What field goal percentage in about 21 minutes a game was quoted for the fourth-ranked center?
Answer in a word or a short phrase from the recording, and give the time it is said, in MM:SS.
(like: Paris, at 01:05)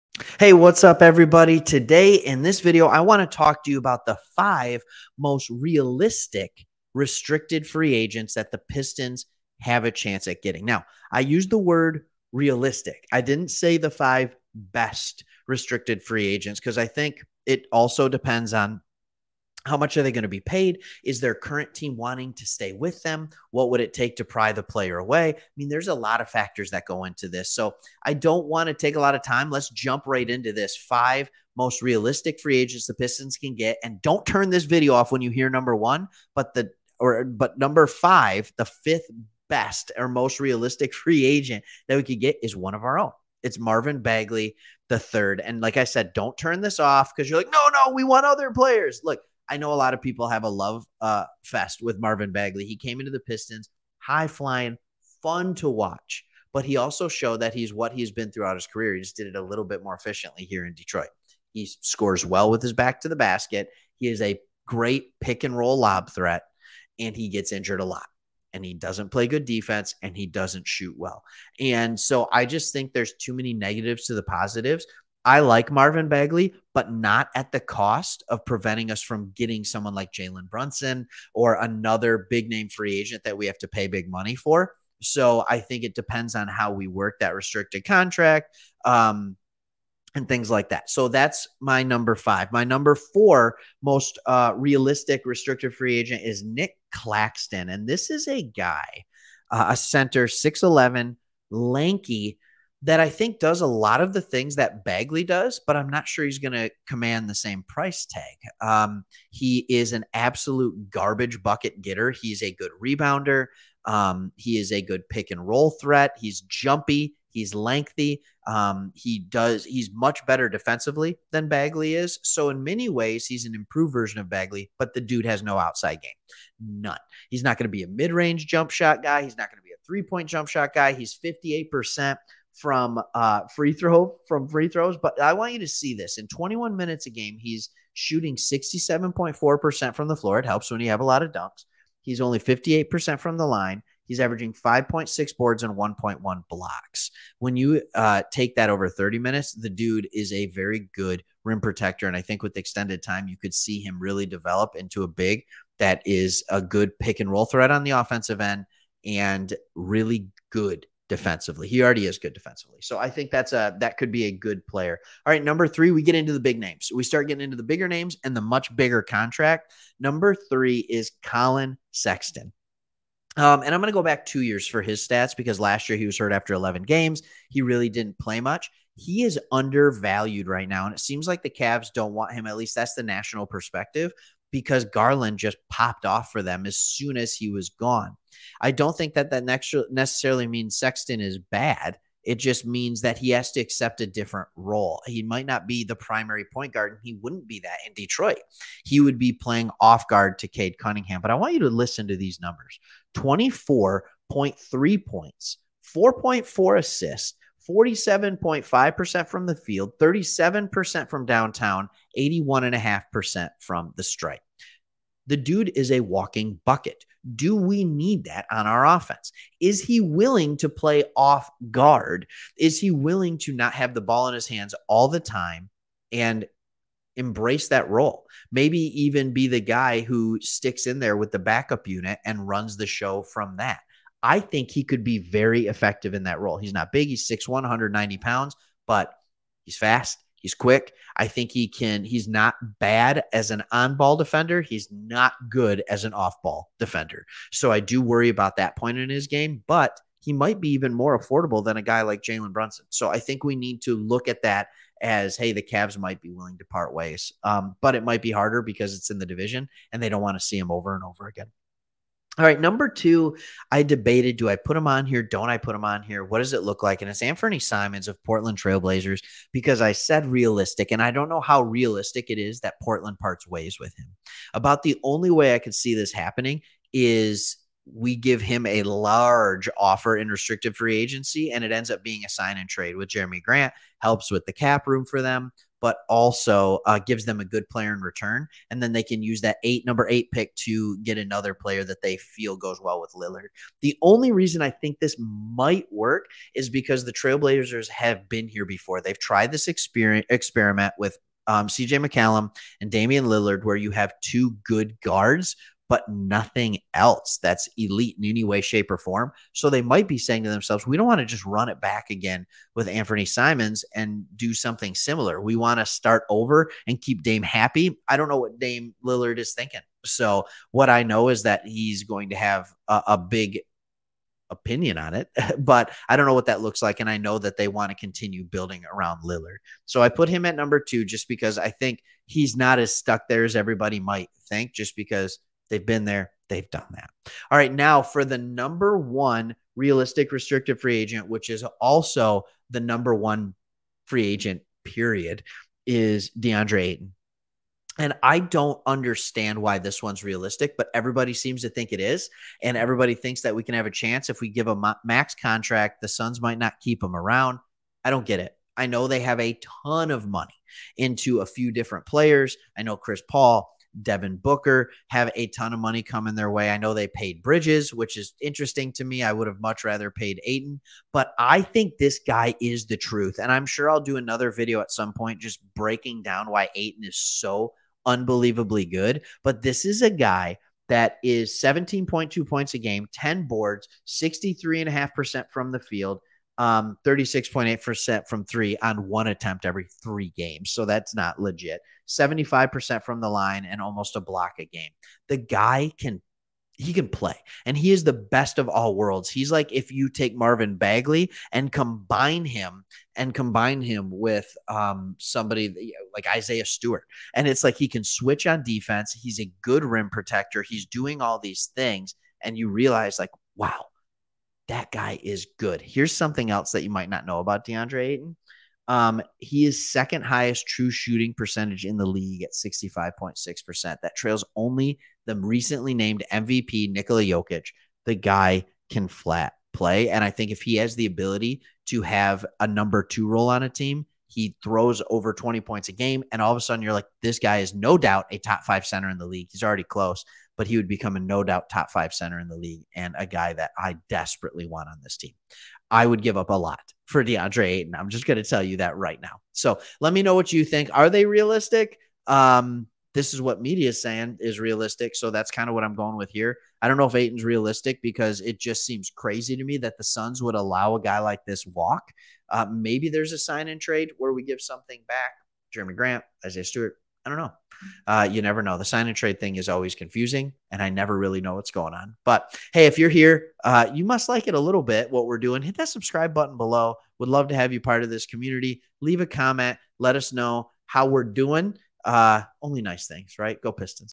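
67.4%, at 02:18.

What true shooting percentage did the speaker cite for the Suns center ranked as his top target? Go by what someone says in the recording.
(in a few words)
65.6%.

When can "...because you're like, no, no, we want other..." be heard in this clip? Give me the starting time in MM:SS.
00:47.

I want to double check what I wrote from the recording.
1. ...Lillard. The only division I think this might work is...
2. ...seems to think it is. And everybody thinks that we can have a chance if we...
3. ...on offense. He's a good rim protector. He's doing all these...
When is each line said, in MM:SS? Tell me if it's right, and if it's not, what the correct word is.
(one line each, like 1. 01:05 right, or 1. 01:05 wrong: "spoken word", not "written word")
1. 04:53 wrong: "reason", not "division"
2. 05:51 right
3. 06:48 wrong: "defense", not "offense".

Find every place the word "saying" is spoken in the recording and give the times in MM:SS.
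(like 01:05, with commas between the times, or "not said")
05:10, 07:34.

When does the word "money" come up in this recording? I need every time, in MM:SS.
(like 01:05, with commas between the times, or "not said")
01:24, 06:00, 06:05.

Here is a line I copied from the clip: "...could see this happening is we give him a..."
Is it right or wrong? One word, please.
right.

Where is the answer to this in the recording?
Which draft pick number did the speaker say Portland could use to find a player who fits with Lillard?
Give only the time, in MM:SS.
04:49.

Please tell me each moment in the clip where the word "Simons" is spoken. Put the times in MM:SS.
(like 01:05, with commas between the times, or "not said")
04:27, 05:13.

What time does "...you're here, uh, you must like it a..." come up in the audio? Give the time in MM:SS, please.
07:52.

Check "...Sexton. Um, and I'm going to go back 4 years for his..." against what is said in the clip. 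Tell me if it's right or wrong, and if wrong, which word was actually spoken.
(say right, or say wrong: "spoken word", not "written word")
wrong: "2", not "4".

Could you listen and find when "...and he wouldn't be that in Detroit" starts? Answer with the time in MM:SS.
03:16.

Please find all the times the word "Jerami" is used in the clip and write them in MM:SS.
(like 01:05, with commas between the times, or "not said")
04:43, 07:45.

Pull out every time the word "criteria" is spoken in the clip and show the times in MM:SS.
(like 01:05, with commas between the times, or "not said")
not said.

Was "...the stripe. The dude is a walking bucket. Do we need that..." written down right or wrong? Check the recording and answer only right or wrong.
right.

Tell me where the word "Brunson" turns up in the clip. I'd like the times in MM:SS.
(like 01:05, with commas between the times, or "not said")
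01:20, 04:12.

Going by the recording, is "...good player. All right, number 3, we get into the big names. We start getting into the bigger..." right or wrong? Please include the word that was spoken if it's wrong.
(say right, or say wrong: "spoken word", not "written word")
right.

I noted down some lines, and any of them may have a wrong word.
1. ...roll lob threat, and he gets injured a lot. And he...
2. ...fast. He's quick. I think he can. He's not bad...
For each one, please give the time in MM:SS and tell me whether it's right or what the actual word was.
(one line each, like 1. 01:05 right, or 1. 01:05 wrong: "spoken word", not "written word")
1. 01:05 right
2. 03:59 right.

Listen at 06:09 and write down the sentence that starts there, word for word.
I would have much rather paid Ayton, but I think this guy is the truth.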